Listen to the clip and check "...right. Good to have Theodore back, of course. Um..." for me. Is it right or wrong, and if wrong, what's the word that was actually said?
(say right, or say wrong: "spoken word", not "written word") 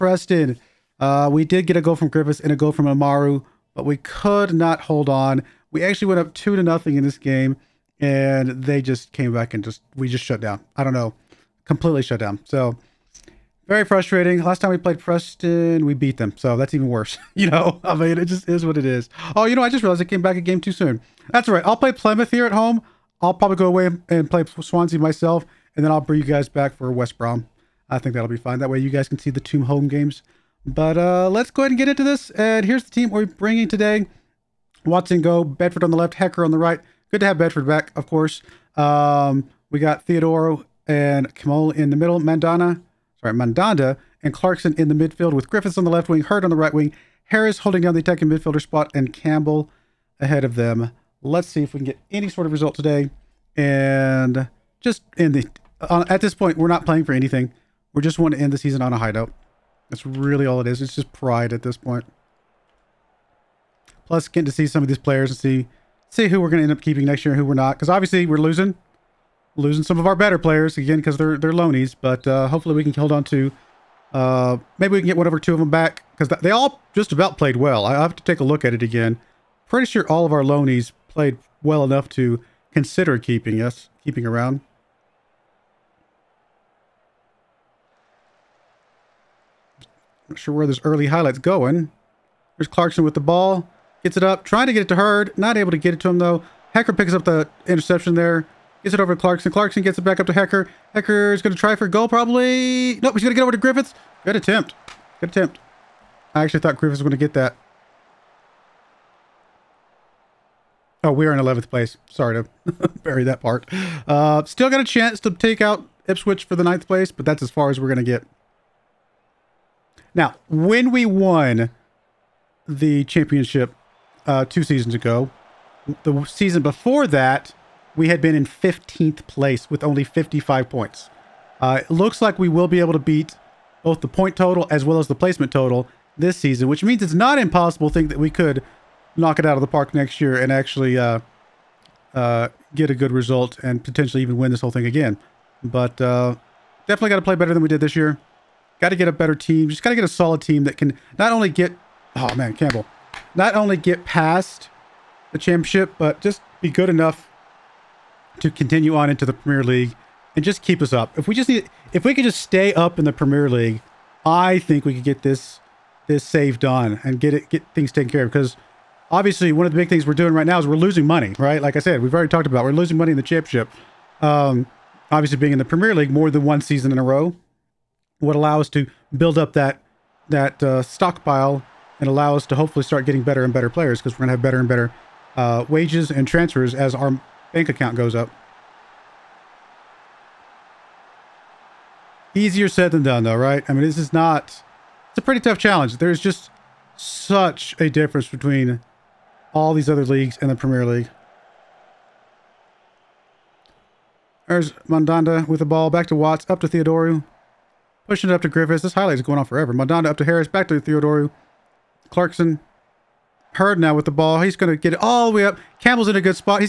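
wrong: "Bedford", not "Theodore".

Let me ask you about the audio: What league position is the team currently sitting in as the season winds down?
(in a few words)
11th.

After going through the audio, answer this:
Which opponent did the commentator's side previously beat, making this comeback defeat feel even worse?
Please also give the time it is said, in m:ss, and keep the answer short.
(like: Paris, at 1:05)
Preston, at 0:14.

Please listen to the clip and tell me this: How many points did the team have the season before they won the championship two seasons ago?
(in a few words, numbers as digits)
55.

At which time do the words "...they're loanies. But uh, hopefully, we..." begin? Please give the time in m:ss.
1:11.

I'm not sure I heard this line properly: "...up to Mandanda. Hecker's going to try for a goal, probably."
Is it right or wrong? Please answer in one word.
wrong.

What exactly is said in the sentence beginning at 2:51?
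Like I said, we've already talked about we're losing money in the championship.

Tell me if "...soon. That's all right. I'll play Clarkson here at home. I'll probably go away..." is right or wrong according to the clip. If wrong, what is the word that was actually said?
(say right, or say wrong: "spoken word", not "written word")
wrong: "Plymouth", not "Clarkson".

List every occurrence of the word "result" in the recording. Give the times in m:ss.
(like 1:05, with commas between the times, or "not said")
0:52, 2:23.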